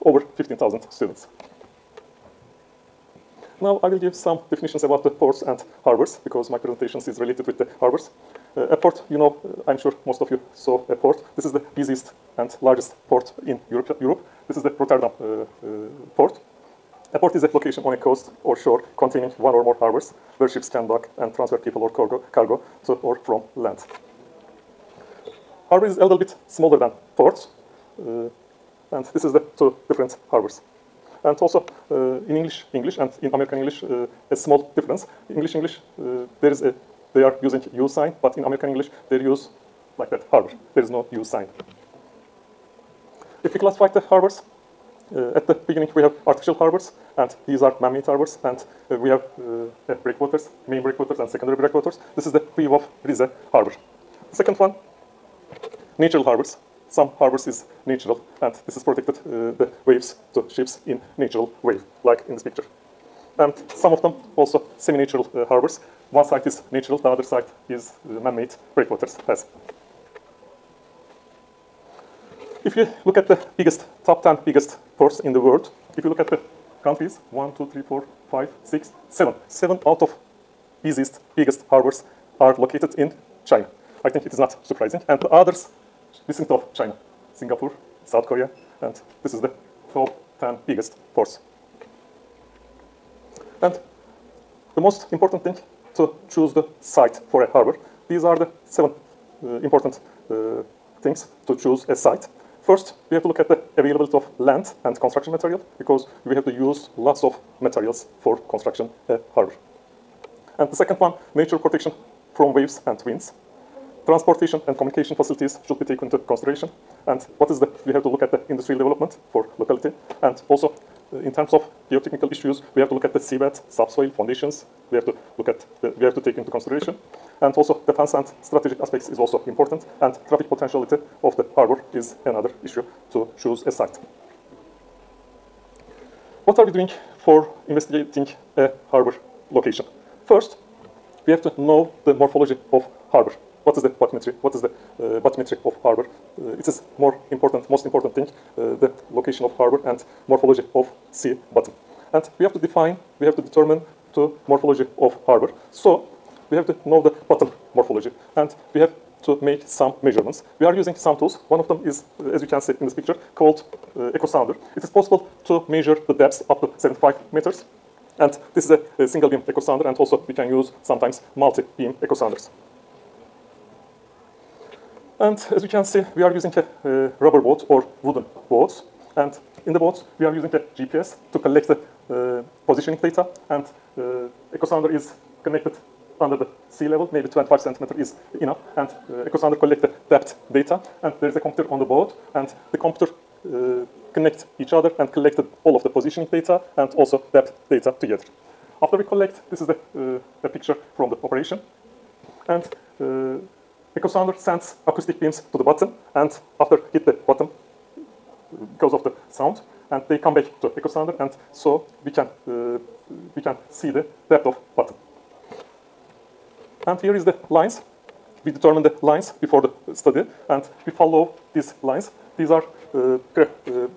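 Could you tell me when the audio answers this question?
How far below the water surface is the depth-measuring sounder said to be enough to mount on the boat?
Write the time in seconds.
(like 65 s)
187 s.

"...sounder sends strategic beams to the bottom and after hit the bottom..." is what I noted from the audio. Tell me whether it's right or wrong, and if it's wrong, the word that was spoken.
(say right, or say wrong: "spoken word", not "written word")
wrong: "acoustic", not "strategic".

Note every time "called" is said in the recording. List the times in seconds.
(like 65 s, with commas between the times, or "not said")
163 s.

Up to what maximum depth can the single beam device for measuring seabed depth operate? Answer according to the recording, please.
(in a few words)
75 meters.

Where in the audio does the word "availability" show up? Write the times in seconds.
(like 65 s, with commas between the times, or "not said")
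103 s.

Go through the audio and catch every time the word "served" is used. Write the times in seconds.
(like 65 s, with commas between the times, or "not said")
not said.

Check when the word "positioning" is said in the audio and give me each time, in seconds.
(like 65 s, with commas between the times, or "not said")
182 s, 195 s.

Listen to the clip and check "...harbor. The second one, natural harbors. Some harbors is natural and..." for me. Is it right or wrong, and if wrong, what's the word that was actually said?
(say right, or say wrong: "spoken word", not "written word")
right.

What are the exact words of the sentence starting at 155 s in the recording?
So we have to know the bottom morphology and we have to make some measurements.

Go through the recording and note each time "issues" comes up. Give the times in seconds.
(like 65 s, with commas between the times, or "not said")
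122 s, 132 s.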